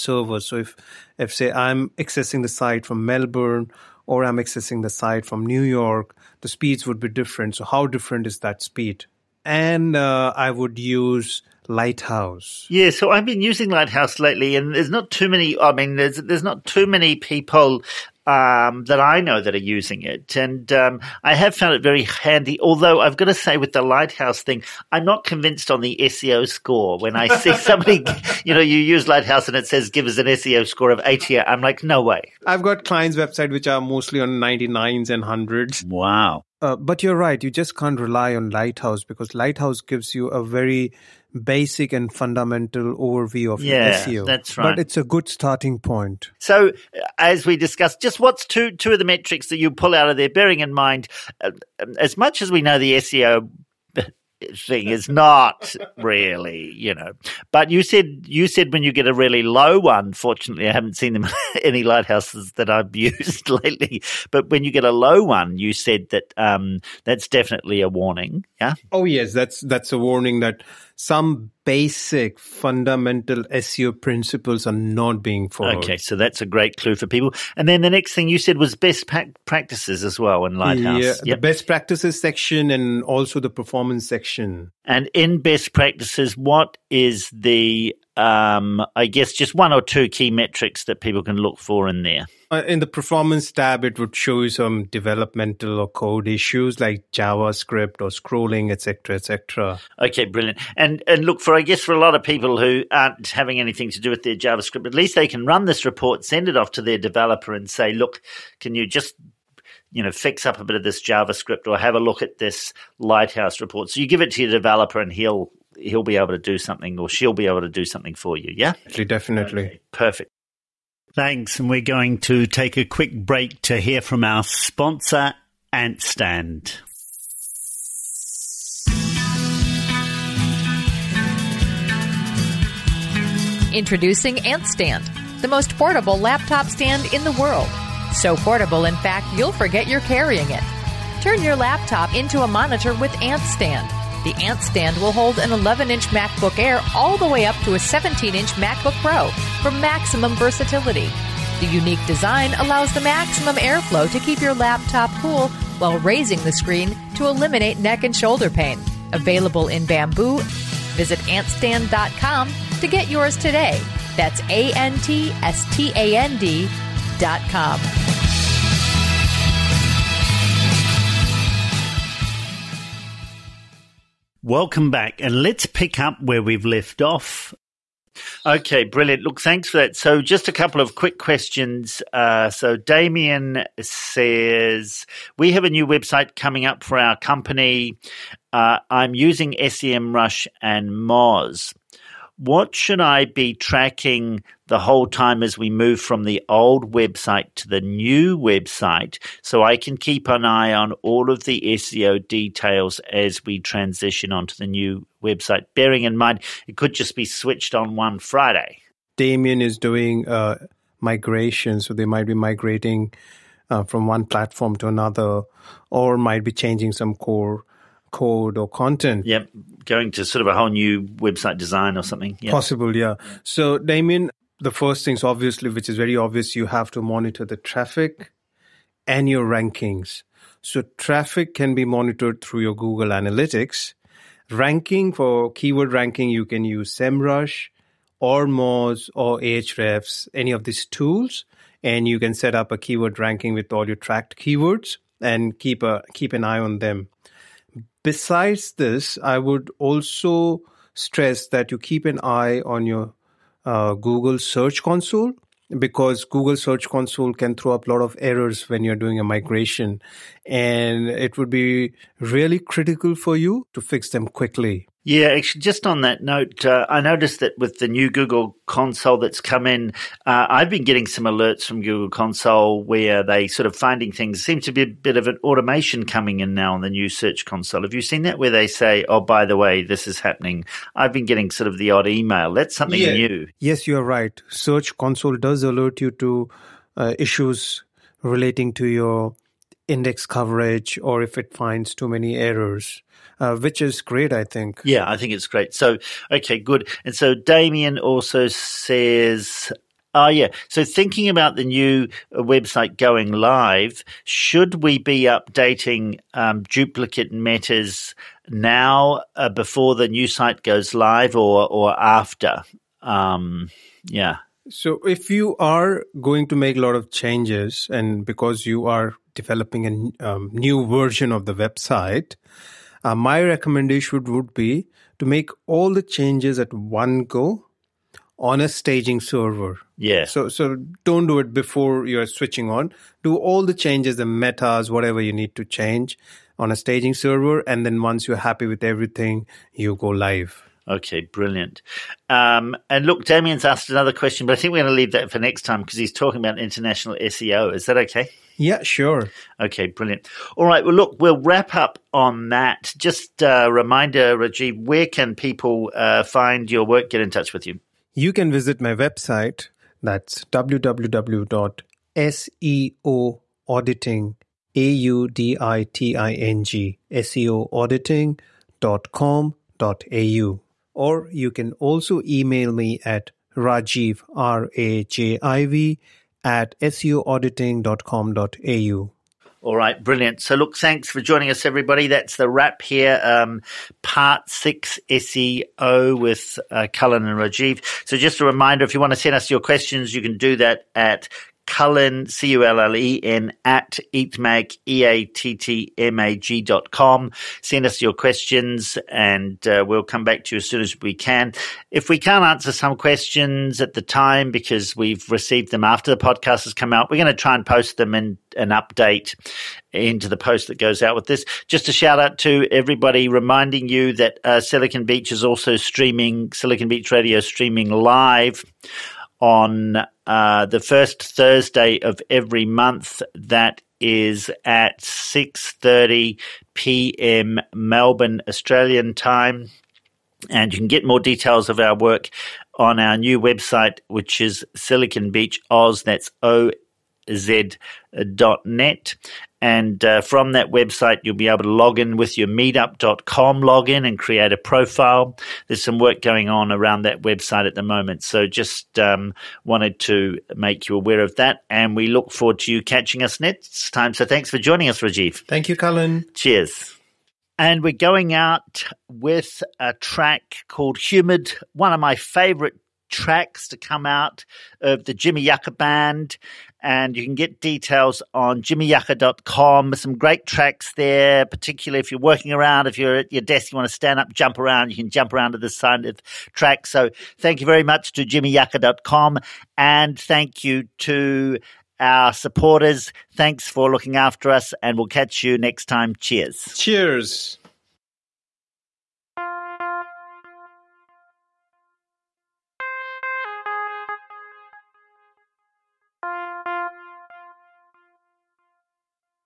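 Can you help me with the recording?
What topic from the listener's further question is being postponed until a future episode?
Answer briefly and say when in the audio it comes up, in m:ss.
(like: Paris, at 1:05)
international SEO, at 5:46.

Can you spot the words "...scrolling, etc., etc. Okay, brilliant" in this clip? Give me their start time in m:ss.
1:38.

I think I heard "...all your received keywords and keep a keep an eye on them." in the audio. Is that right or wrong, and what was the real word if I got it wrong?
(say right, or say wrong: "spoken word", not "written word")
wrong: "tracked", not "received".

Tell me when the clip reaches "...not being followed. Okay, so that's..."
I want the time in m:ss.
1:14.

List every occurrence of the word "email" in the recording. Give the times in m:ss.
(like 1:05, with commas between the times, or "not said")
4:42, 6:12.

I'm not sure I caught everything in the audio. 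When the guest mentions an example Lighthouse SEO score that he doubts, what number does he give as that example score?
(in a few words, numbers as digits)
80.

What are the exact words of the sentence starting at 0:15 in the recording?
I mean, there's there's not too many people um, that I know that are using it.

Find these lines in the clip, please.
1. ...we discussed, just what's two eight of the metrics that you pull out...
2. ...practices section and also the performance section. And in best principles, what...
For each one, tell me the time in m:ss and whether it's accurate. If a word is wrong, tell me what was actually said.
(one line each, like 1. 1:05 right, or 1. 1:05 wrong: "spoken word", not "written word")
1. 0:47 wrong: "two", not "eight"
2. 1:21 wrong: "practices", not "principles".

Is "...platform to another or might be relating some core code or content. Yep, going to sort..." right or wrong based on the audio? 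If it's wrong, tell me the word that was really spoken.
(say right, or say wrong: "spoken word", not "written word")
wrong: "changing", not "relating".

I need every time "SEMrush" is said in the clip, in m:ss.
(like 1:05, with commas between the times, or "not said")
3:09, 3:56.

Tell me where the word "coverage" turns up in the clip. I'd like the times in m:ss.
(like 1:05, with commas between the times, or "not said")
4:50.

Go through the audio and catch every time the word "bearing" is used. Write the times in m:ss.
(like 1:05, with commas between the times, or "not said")
0:50, 3:25.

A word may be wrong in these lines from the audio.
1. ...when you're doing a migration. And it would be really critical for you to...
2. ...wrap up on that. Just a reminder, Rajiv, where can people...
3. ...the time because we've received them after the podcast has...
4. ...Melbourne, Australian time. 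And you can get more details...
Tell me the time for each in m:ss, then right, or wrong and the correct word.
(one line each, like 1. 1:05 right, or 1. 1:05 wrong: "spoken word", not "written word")
1. 4:18 right
2. 5:51 right
3. 6:43 right
4. 7:07 right.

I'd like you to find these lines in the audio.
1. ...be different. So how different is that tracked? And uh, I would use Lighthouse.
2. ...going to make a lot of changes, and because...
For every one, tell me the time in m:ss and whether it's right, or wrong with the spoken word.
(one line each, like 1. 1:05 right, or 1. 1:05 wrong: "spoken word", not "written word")
1. 0:06 wrong: "speed", not "tracked"
2. 5:16 right.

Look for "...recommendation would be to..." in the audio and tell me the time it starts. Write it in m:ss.
5:23.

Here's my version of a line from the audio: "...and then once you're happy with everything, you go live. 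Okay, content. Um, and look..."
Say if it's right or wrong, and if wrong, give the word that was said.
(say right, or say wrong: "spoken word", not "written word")
wrong: "brilliant", not "content".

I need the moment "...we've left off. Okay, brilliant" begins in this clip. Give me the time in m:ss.
2:56.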